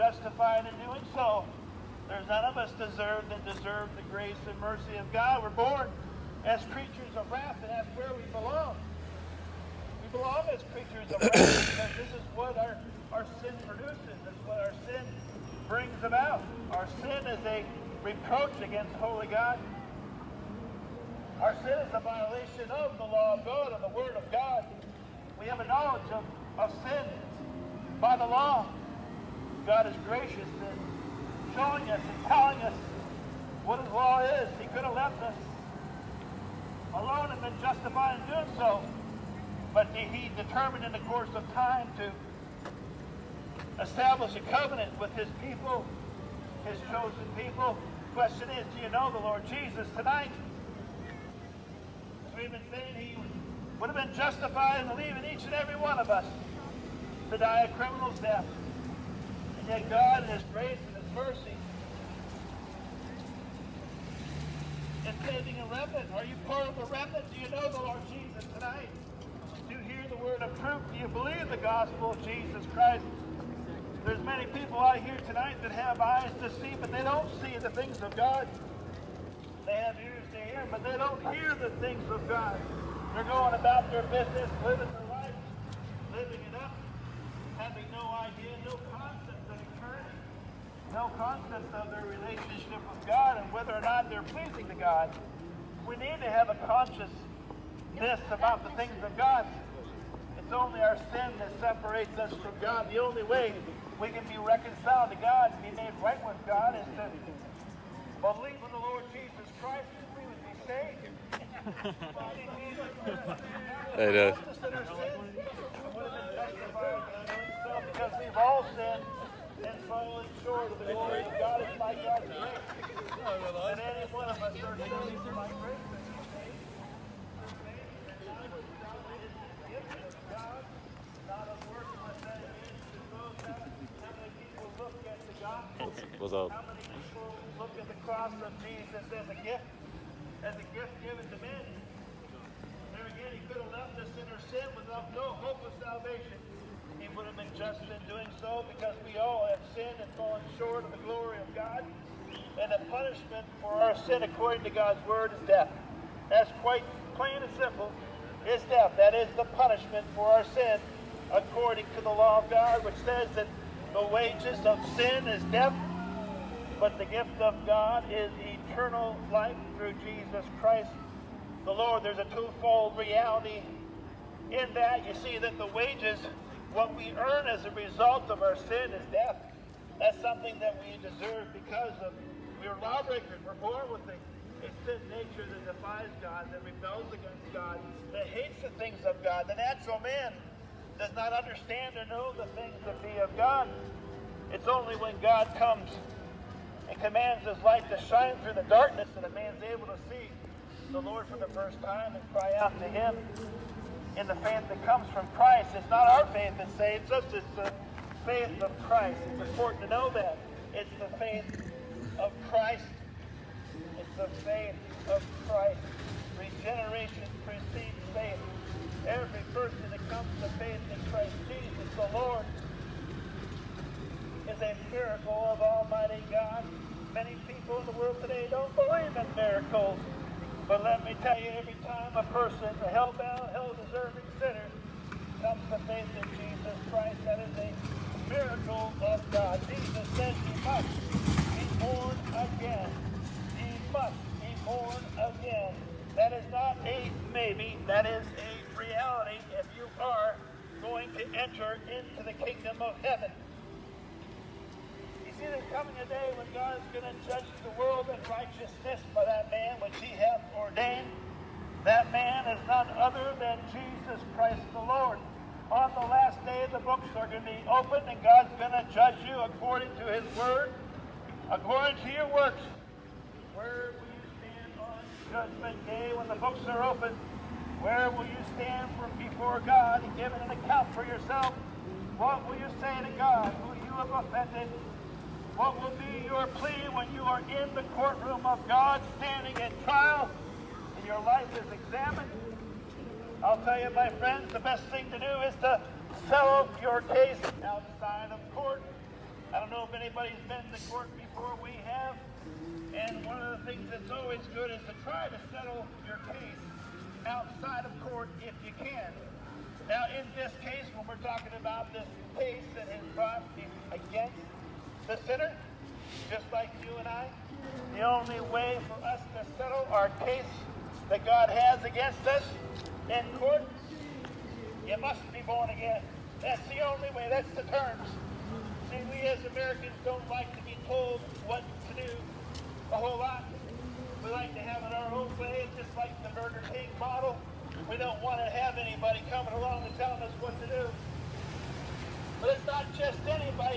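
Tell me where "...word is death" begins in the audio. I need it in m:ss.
2:35.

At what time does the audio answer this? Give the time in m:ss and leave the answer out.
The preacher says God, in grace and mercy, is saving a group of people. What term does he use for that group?
1:05.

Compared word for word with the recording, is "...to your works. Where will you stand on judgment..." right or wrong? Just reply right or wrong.
right.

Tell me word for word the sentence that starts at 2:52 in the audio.
There's a twofold reality in that.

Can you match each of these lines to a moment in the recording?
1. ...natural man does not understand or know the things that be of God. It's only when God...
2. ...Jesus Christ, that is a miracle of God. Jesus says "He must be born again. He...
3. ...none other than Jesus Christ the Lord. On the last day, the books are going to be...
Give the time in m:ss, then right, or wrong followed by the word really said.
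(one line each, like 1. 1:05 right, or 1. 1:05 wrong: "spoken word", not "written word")
1. 3:09 right
2. 3:56 right
3. 4:22 right.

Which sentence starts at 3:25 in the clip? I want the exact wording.
It's not our faith that saves us, it's the faith of Christ.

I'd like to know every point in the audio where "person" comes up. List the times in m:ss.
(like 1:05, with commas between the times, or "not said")
3:39, 3:52.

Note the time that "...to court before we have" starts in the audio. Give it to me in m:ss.
5:00.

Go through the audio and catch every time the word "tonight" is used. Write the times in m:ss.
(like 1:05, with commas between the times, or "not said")
0:49, 1:08, 1:15.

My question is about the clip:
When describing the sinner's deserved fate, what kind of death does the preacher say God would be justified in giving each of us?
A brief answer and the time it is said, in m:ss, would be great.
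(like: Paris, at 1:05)
A criminal's death, at 0:57.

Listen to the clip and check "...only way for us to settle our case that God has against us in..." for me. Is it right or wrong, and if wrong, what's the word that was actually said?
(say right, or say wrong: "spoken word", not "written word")
right.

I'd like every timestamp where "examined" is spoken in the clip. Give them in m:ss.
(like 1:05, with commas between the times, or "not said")
4:51.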